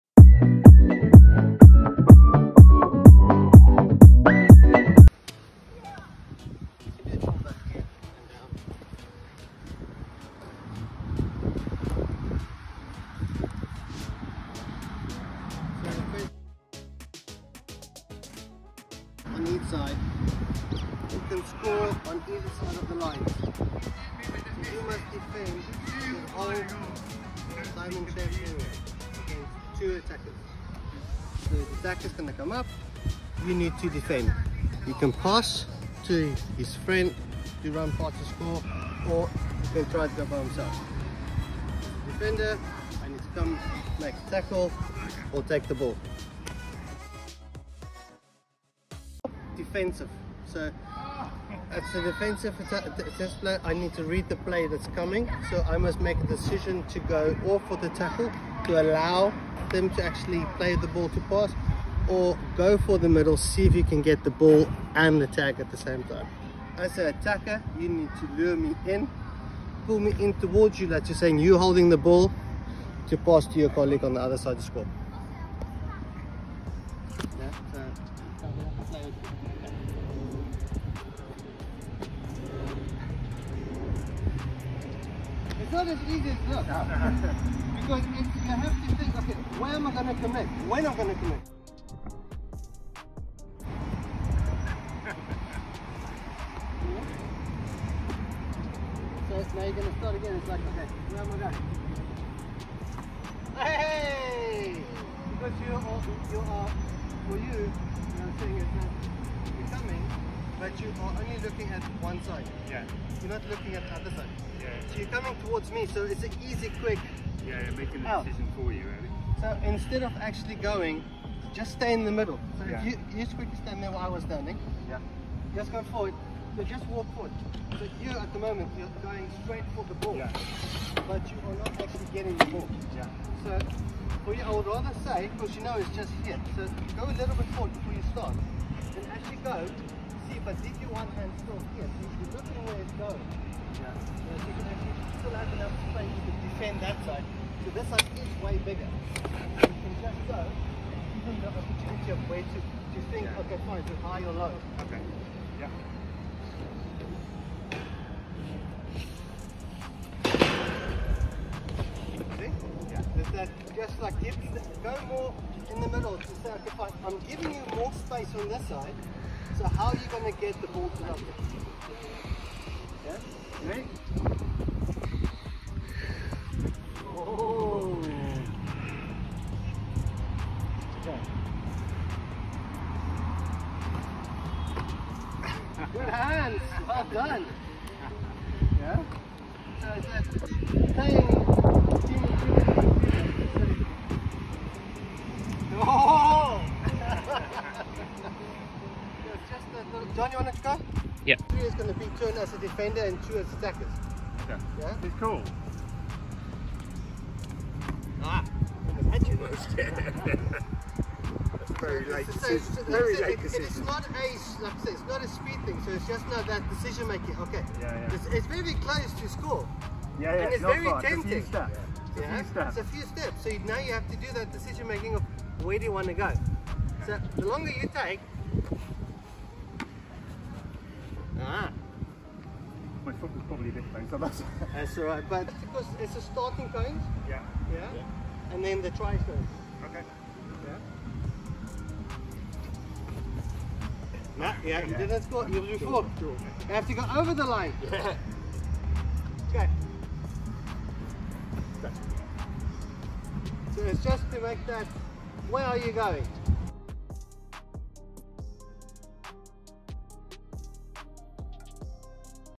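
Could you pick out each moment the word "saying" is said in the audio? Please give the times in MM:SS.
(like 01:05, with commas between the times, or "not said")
01:11, 01:49.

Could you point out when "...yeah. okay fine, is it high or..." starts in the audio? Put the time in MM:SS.
02:33.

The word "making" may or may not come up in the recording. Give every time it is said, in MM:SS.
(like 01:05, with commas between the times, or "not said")
01:57, 03:37, 03:44.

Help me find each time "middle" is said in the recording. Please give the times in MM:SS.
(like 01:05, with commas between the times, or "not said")
01:03, 02:02, 02:45.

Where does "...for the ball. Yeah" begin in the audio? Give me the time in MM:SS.
02:09.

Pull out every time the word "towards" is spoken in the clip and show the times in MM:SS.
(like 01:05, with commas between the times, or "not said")
01:10, 01:55.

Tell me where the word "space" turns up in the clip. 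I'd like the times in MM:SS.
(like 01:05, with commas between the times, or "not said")
02:25, 02:47.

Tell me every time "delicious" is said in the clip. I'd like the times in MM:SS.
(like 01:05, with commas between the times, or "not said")
not said.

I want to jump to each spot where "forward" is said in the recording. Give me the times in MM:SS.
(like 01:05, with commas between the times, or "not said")
02:05, 02:17.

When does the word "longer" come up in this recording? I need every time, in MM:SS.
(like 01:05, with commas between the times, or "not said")
03:47.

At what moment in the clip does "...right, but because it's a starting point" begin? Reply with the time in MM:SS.
03:55.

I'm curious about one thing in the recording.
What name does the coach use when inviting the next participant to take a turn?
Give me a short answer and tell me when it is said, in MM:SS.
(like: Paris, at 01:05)
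John, at 03:20.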